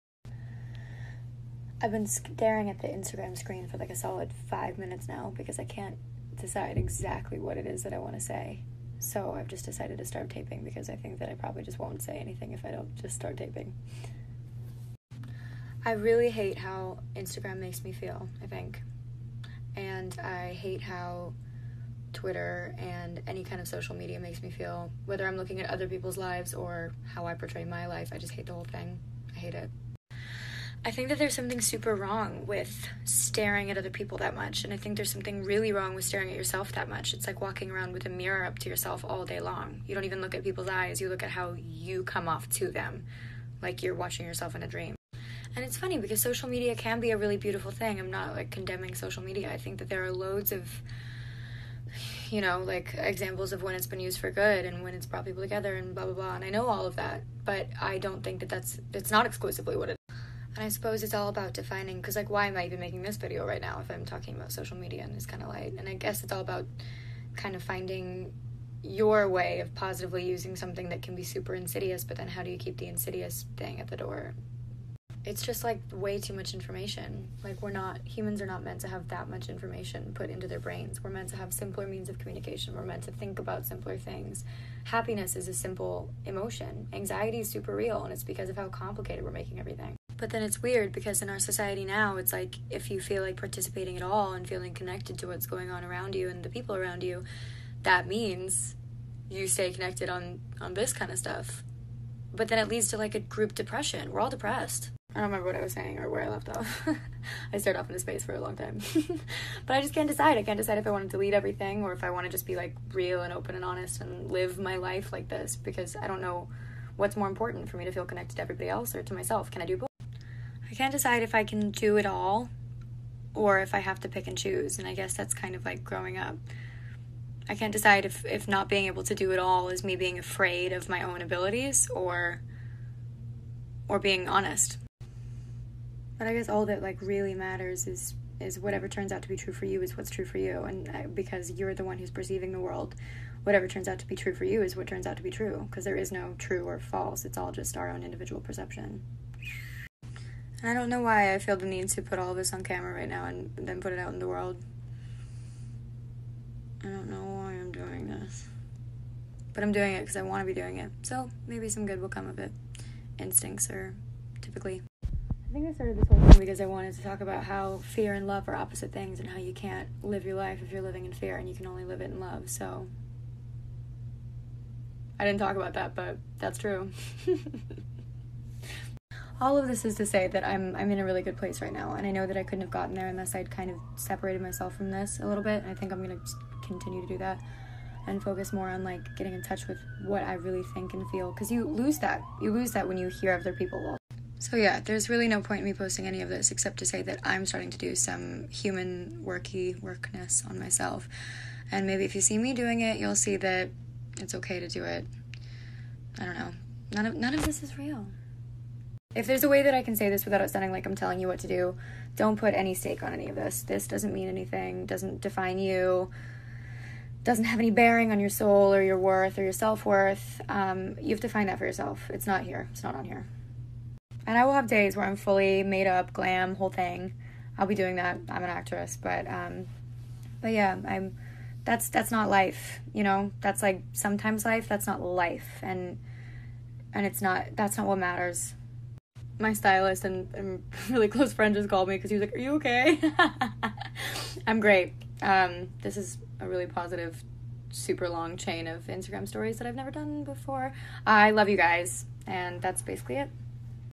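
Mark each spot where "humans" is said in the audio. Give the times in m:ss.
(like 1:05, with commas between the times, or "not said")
1:18, 3:18.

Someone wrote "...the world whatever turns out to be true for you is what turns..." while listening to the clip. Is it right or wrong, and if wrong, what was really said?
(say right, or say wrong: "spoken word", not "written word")
right.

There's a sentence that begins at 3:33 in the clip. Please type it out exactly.
This doesn't mean anything, doesn't define you, doesn't have any bearing on your soul or your worth or your self worth.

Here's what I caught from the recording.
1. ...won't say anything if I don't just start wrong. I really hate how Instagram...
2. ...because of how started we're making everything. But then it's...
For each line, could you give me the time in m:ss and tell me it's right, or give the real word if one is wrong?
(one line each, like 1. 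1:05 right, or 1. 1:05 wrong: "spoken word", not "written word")
1. 0:11 wrong: "taping", not "wrong"
2. 1:28 wrong: "complicated", not "started".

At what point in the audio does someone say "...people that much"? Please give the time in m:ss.
0:33.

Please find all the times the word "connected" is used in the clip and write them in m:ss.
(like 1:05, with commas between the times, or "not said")
1:34, 1:39, 1:58.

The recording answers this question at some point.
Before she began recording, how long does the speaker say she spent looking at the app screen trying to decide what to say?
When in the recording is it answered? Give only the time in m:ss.
0:04.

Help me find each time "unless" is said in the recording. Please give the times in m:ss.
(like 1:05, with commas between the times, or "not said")
3:03.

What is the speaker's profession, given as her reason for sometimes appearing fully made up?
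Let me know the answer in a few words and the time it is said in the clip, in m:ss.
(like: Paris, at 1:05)
actress, at 3:48.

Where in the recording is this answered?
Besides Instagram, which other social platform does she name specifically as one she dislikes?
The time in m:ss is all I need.
0:22.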